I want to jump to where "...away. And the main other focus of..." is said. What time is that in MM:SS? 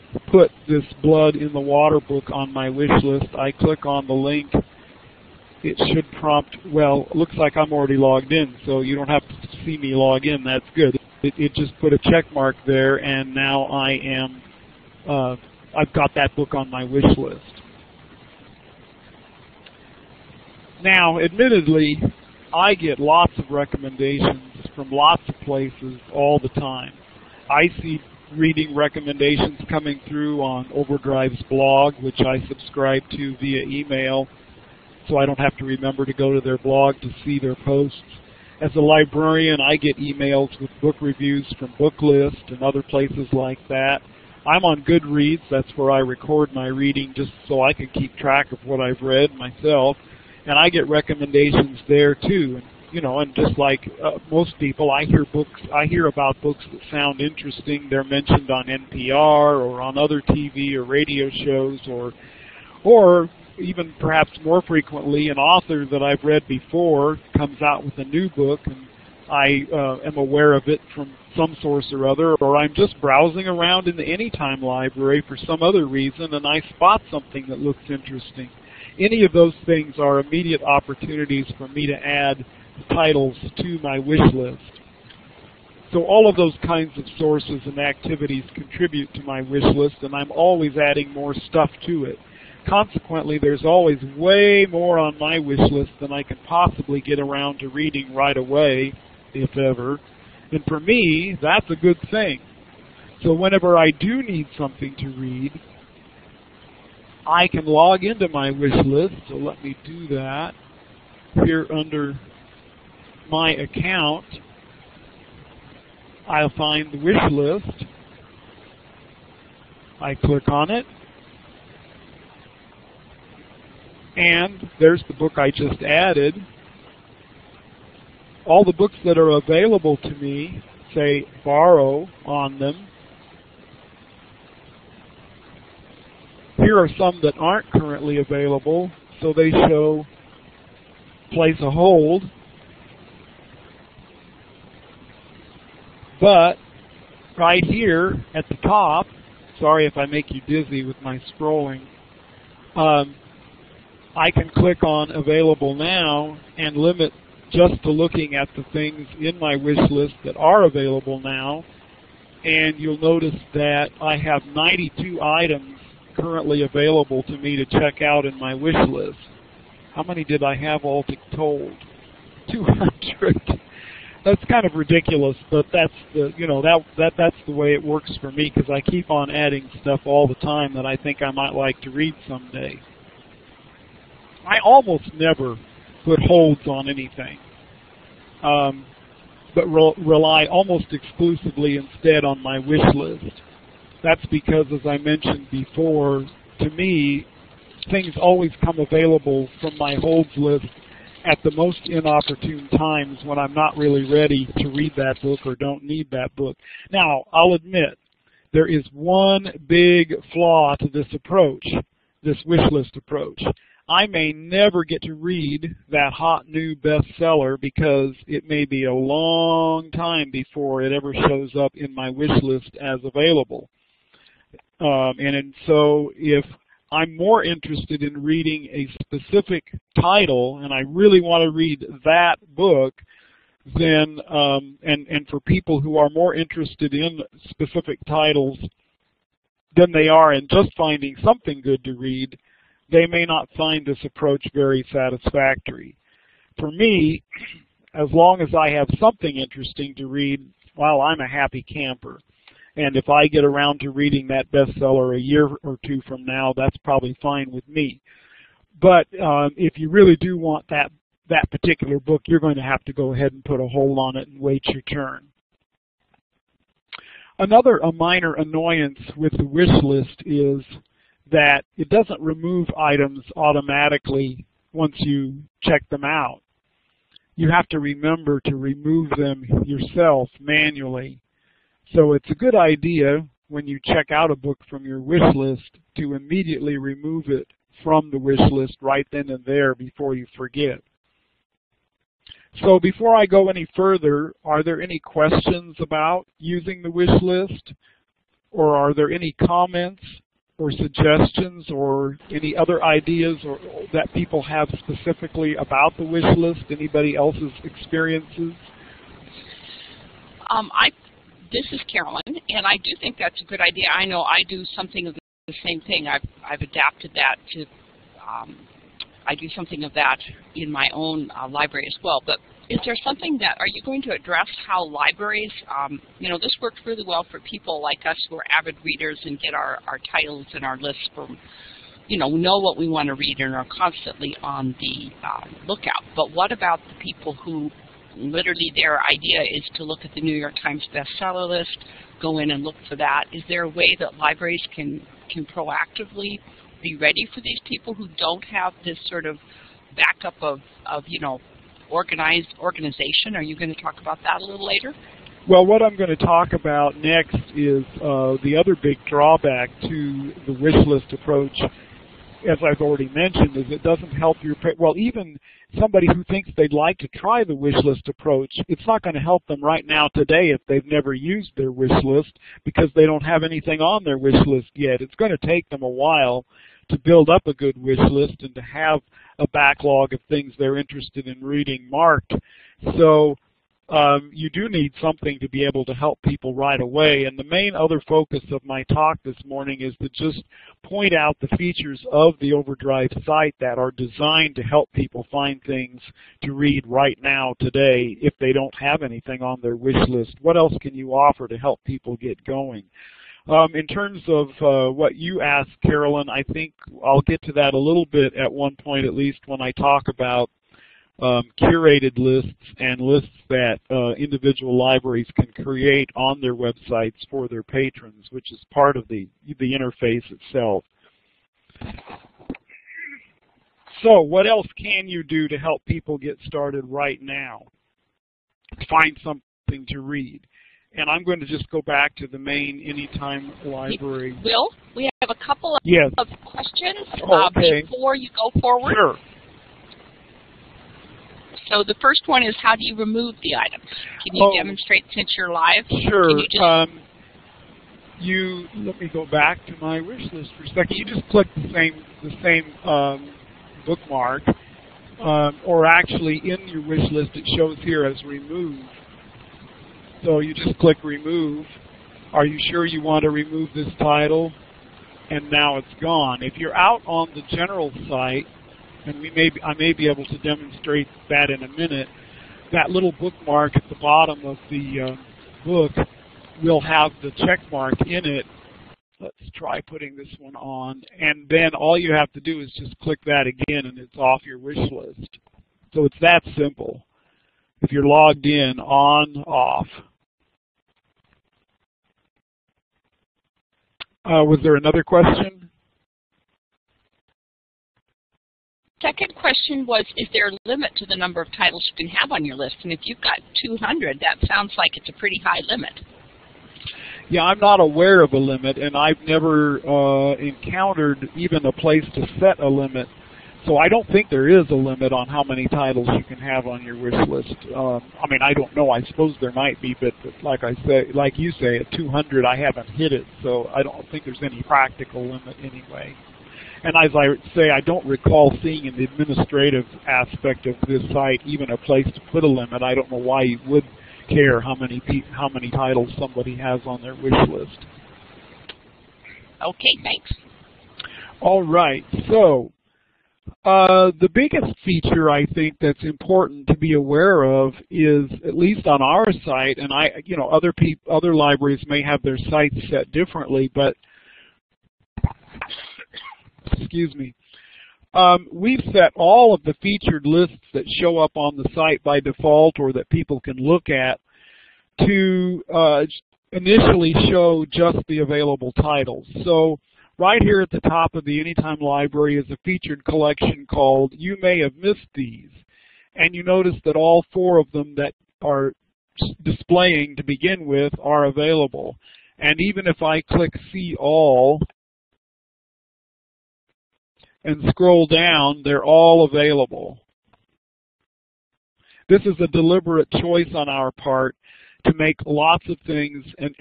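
06:26.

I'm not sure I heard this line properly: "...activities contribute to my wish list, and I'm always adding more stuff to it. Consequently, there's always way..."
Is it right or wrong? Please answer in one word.
right.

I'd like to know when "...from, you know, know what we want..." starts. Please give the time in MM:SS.
05:31.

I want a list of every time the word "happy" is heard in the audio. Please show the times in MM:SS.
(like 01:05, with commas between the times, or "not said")
04:11.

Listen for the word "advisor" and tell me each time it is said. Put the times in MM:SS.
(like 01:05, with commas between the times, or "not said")
not said.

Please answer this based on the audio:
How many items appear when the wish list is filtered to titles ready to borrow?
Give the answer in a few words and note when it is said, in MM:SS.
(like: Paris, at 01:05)
92, at 02:44.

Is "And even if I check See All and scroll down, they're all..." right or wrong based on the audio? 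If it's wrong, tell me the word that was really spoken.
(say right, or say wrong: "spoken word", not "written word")
wrong: "click", not "check".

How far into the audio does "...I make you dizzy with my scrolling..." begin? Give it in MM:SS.
02:29.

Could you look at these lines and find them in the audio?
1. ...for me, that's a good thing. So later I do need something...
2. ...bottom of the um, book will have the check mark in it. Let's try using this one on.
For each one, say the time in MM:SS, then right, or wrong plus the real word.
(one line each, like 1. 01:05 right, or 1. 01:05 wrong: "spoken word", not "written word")
1. 01:40 wrong: "whenever", not "later"
2. 07:54 wrong: "putting", not "using".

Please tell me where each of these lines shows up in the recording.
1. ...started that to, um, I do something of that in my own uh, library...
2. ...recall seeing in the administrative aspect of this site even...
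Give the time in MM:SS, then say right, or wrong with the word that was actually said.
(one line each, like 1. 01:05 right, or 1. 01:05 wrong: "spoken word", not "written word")
1. 05:16 wrong: "adapted", not "started"
2. 08:48 right.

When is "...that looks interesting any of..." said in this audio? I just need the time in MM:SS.
01:17.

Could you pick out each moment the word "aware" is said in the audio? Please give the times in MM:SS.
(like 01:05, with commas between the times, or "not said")
01:10, 08:27, 09:06.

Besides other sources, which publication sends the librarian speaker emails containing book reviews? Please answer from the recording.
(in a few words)
Booklist.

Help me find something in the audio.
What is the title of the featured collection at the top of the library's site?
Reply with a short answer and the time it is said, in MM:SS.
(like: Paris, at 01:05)
You May Have Missed These, at 09:34.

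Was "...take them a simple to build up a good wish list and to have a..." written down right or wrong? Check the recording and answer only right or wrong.
wrong.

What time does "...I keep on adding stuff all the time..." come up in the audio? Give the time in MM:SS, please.
02:58.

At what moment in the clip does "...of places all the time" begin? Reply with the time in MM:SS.
00:25.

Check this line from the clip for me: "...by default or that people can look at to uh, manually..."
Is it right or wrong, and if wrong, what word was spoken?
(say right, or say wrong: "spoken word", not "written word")
wrong: "initially", not "manually".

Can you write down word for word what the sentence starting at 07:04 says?
So what else can you do to help people get started right now?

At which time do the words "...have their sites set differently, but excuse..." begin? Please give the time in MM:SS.
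09:12.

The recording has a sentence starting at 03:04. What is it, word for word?
I almost never put holds on anything, um, but re- rely almost exclusively instead on my wish list.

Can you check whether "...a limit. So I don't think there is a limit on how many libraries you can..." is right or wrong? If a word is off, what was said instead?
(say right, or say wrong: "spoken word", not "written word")
wrong: "titles", not "libraries".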